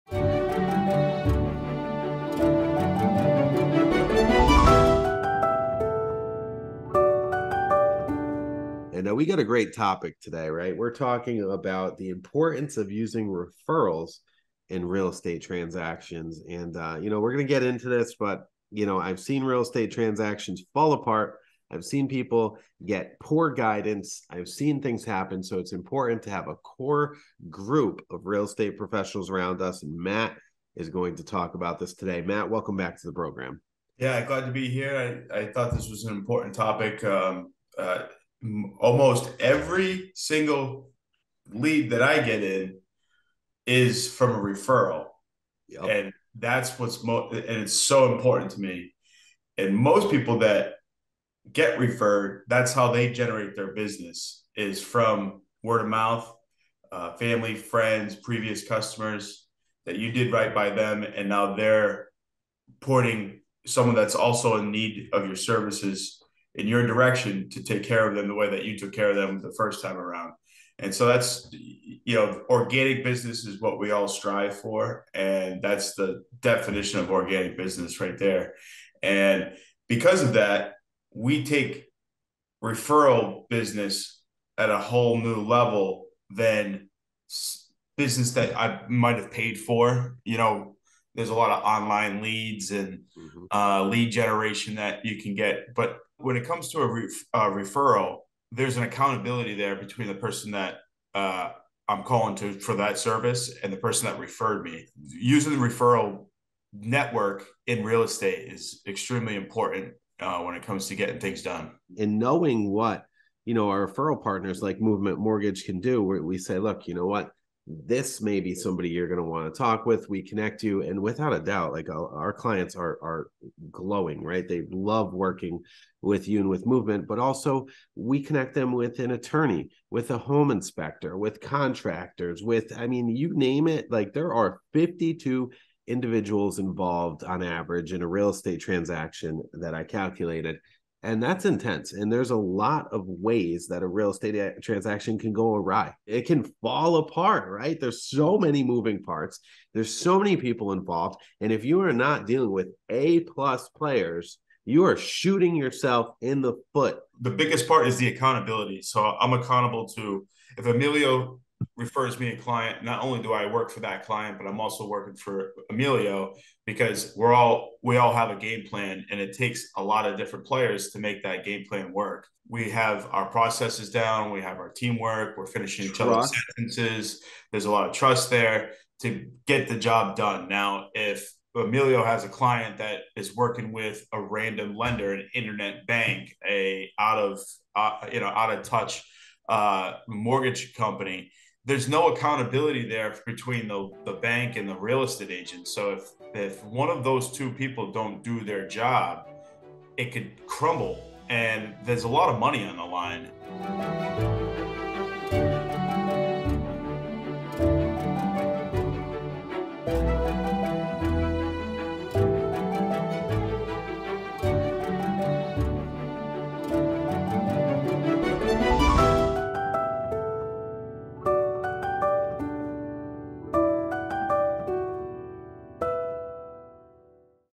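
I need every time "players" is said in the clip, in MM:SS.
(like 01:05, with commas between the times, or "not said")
02:33, 02:50.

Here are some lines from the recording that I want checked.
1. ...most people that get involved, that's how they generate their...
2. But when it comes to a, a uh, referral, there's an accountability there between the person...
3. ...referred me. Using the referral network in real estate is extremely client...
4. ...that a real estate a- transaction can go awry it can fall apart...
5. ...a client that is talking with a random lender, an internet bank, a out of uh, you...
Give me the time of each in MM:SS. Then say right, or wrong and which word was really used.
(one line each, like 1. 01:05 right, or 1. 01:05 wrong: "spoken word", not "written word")
1. 00:49 wrong: "referred", not "involved"
2. 01:35 right
3. 01:44 wrong: "important", not "client"
4. 02:23 right
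5. 03:02 wrong: "working", not "talking".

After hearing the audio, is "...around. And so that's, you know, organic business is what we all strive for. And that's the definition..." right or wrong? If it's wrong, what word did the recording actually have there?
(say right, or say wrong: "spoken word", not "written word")
right.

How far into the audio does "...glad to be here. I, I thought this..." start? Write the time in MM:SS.
00:34.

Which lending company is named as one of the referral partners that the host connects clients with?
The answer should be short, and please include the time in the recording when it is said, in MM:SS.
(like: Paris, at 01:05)
Movement Mortgage, at 01:54.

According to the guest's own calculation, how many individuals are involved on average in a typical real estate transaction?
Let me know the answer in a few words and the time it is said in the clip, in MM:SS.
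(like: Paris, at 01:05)
52, at 02:14.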